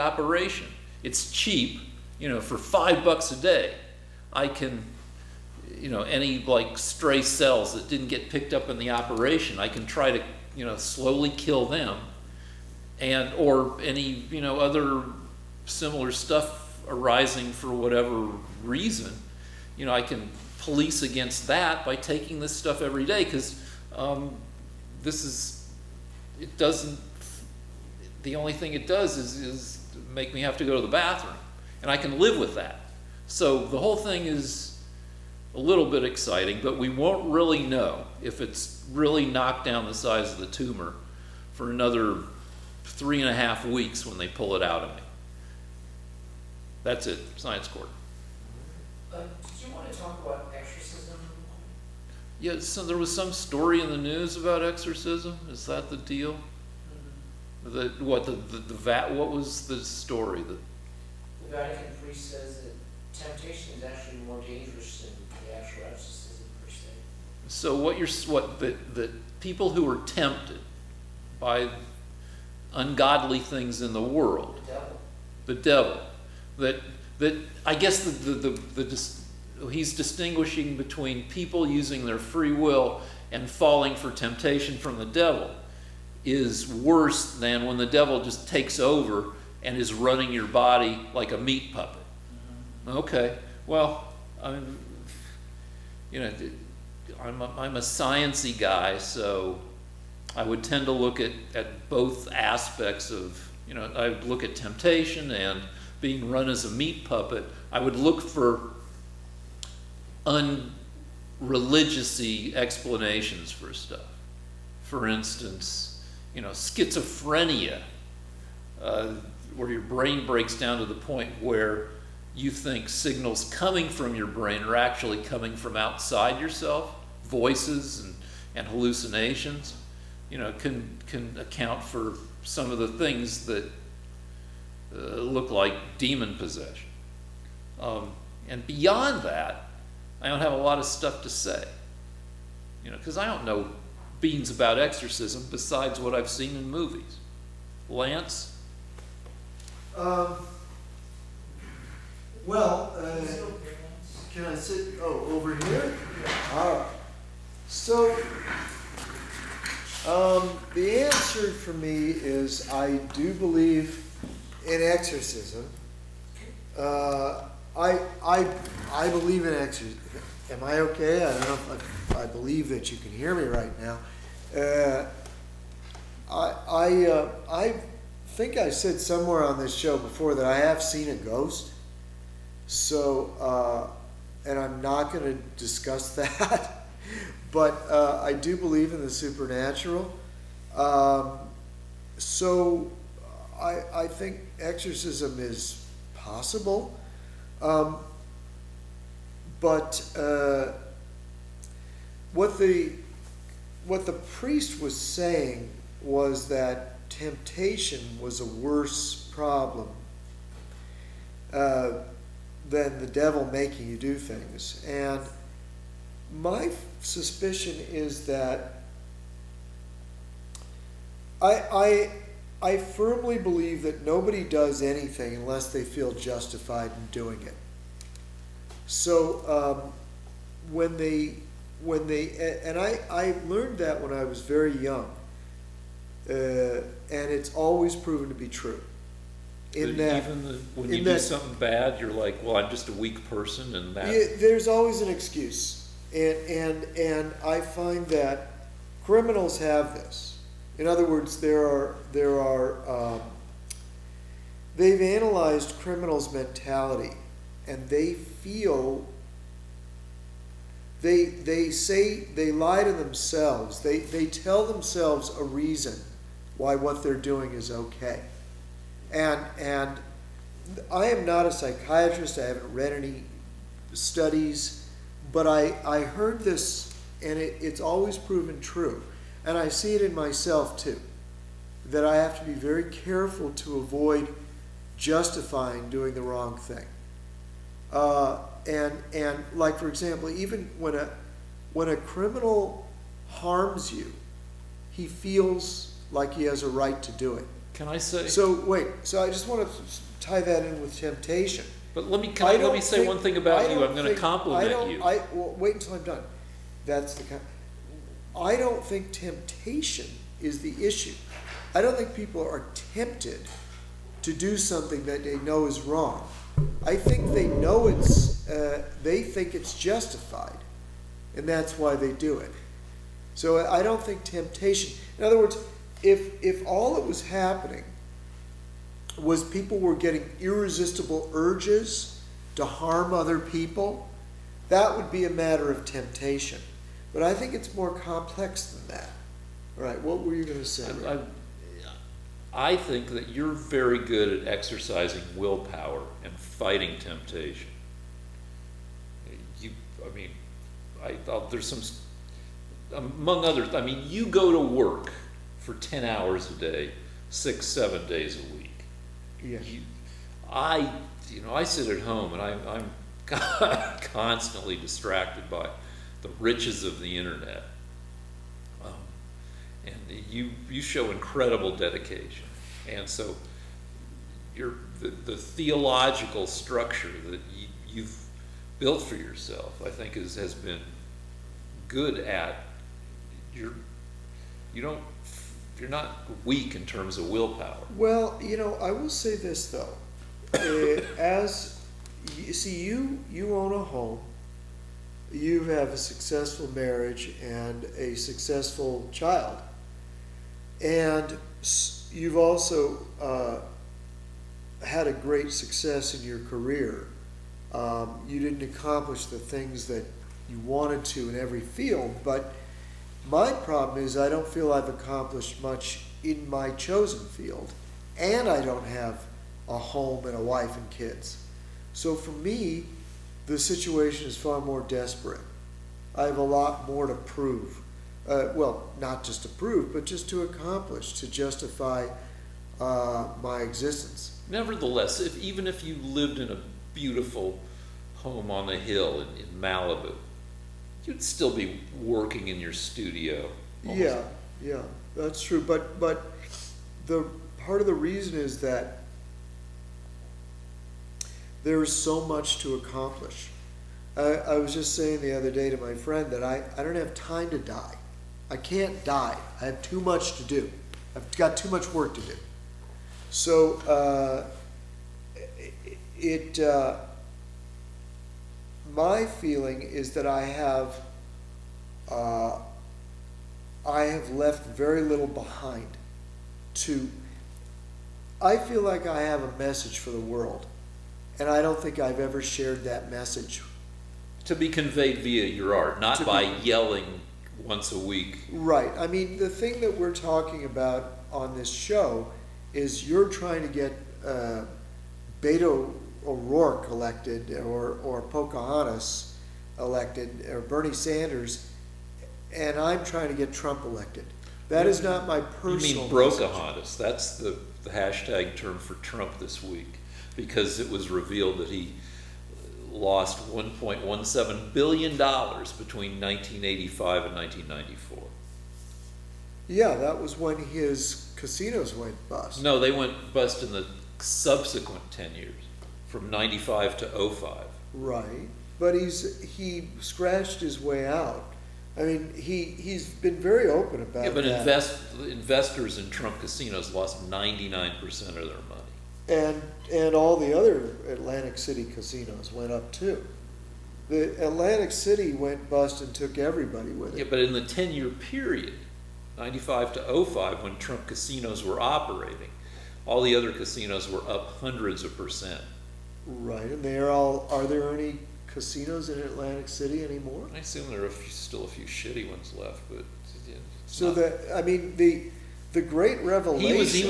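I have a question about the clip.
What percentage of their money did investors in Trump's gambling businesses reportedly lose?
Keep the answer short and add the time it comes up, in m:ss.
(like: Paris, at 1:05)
99%, at 8:57.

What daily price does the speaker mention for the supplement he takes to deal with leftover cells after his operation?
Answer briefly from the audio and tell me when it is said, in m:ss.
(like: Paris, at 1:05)
$5 a day, at 0:02.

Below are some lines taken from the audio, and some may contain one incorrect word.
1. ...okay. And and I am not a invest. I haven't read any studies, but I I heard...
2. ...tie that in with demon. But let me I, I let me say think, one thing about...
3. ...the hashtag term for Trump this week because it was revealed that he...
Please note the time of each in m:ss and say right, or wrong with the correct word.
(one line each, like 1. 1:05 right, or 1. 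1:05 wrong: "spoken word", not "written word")
1. 4:27 wrong: "psychiatrist", not "invest"
2. 5:00 wrong: "temptation", not "demon"
3. 8:27 right.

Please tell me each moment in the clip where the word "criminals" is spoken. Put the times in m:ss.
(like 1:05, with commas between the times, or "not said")
4:09, 4:15, 4:51.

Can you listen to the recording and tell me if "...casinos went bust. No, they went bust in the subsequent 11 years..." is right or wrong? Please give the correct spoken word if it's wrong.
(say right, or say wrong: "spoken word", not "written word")
wrong: "10", not "11".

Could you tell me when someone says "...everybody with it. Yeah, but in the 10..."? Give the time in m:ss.
9:06.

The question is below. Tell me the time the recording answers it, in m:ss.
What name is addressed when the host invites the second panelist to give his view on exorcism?
2:27.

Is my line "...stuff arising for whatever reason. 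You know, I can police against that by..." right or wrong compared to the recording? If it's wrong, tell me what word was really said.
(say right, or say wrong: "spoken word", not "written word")
right.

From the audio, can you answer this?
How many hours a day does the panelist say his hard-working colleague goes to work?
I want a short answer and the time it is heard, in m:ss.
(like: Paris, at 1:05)
10 hours, at 5:55.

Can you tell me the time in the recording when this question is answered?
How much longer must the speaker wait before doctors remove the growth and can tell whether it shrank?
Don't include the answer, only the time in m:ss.
0:42.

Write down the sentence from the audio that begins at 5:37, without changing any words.
But I think it's more complex than that.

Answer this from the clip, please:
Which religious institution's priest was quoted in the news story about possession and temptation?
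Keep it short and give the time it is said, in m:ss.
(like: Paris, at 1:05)
The Vatican, at 1:01.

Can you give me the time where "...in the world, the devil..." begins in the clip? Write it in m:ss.
1:13.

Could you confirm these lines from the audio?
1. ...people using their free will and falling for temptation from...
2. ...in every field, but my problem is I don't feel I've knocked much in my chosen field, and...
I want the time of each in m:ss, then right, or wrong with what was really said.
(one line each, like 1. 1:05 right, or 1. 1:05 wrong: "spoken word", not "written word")
1. 1:21 right
2. 6:51 wrong: "accomplished", not "knocked".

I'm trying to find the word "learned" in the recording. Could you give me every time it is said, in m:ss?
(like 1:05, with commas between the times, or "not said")
3:53.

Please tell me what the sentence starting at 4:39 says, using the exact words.
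And I see it in myself too, that I have to be very careful to avoid justifying doing the wrong thing.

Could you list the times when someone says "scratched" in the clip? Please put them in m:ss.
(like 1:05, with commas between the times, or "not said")
8:50.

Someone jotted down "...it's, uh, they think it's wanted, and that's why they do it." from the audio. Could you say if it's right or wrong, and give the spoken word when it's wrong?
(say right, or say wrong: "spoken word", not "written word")
wrong: "justified", not "wanted".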